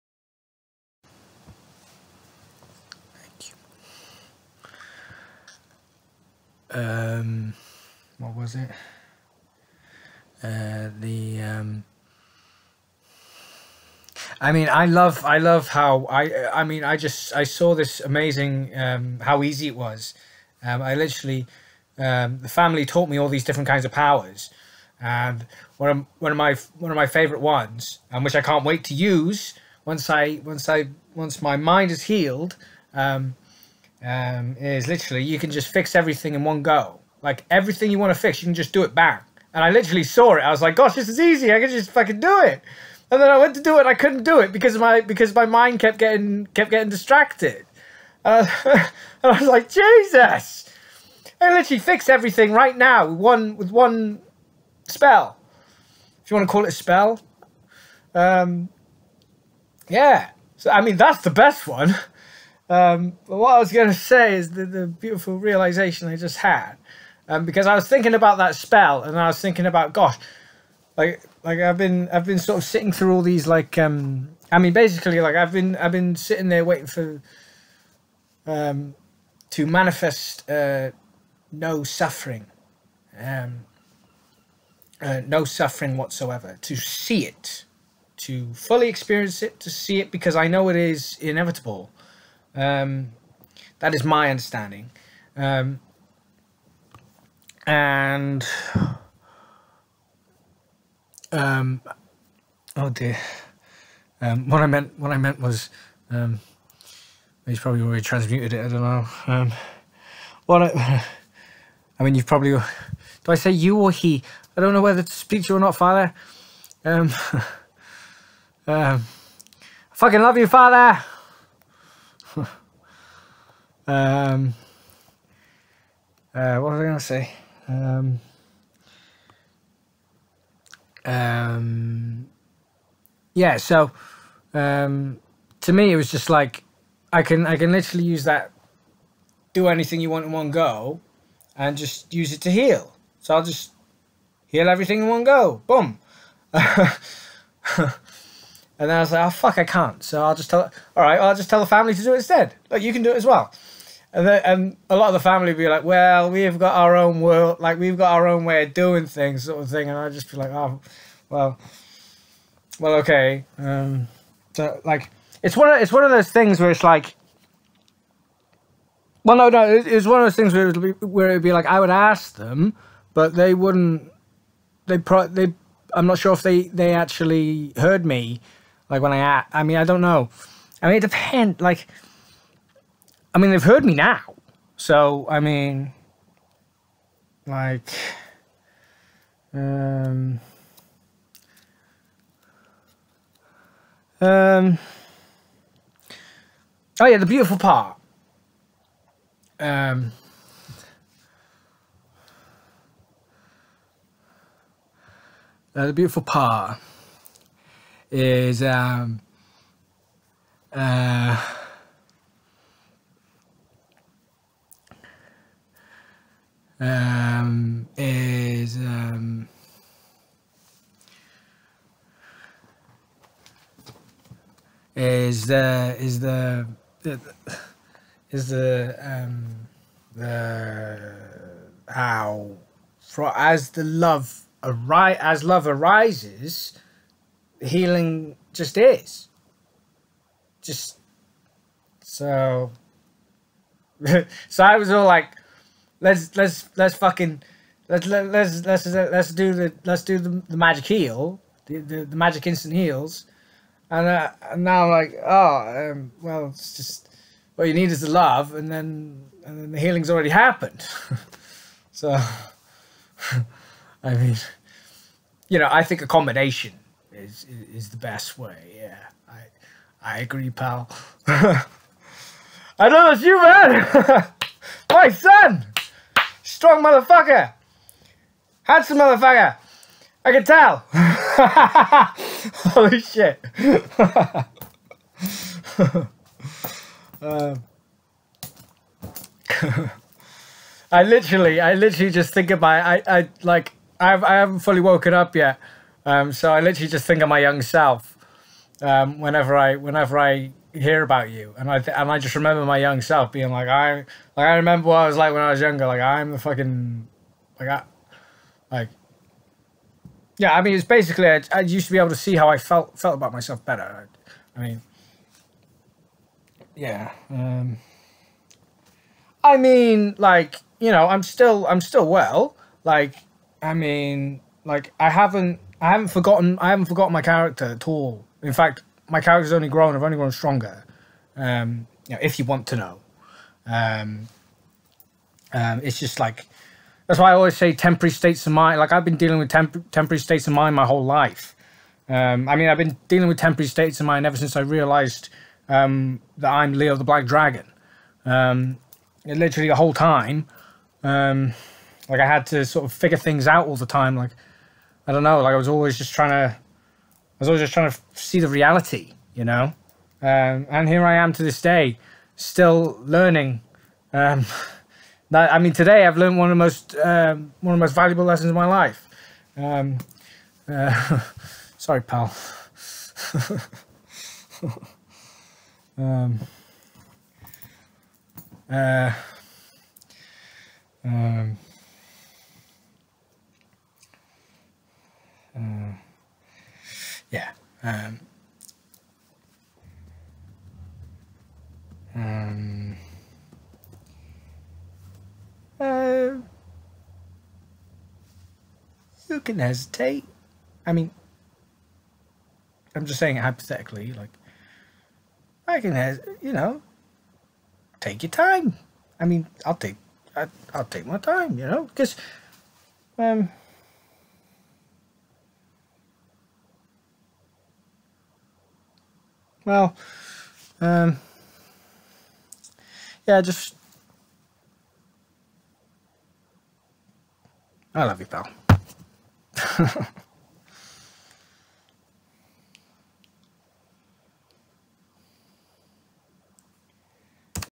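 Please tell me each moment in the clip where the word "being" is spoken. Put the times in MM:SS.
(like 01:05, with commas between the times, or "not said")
05:03.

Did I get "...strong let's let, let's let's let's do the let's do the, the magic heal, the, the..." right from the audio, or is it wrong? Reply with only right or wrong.
wrong.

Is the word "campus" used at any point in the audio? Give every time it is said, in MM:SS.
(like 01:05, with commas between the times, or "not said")
not said.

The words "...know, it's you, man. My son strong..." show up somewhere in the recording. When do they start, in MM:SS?
04:32.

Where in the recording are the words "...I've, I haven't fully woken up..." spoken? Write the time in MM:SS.
04:53.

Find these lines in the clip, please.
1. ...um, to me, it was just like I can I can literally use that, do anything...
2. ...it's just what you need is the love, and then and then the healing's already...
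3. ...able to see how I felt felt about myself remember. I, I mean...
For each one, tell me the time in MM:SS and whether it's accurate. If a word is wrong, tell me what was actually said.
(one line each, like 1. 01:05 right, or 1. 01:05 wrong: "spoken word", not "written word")
1. 02:14 right
2. 04:16 right
3. 05:11 wrong: "better", not "remember".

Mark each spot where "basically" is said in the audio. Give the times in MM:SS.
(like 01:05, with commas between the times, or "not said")
01:14, 05:10.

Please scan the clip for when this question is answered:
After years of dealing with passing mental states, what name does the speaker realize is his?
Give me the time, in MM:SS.
05:46.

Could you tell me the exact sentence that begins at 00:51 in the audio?
I literally fix everything right now with one with one spell.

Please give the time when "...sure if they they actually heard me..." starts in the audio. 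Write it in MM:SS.
02:56.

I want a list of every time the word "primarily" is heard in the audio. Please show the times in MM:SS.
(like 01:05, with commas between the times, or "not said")
not said.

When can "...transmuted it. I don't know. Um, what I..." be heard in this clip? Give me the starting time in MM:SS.
01:48.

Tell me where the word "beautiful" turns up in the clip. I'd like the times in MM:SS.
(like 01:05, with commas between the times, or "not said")
01:04, 03:17, 03:25.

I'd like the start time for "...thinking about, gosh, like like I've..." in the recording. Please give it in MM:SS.
01:09.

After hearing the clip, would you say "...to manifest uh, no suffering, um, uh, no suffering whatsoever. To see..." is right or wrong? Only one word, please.
right.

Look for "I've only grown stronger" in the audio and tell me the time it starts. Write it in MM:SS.
05:29.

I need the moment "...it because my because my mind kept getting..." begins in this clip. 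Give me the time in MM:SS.
00:44.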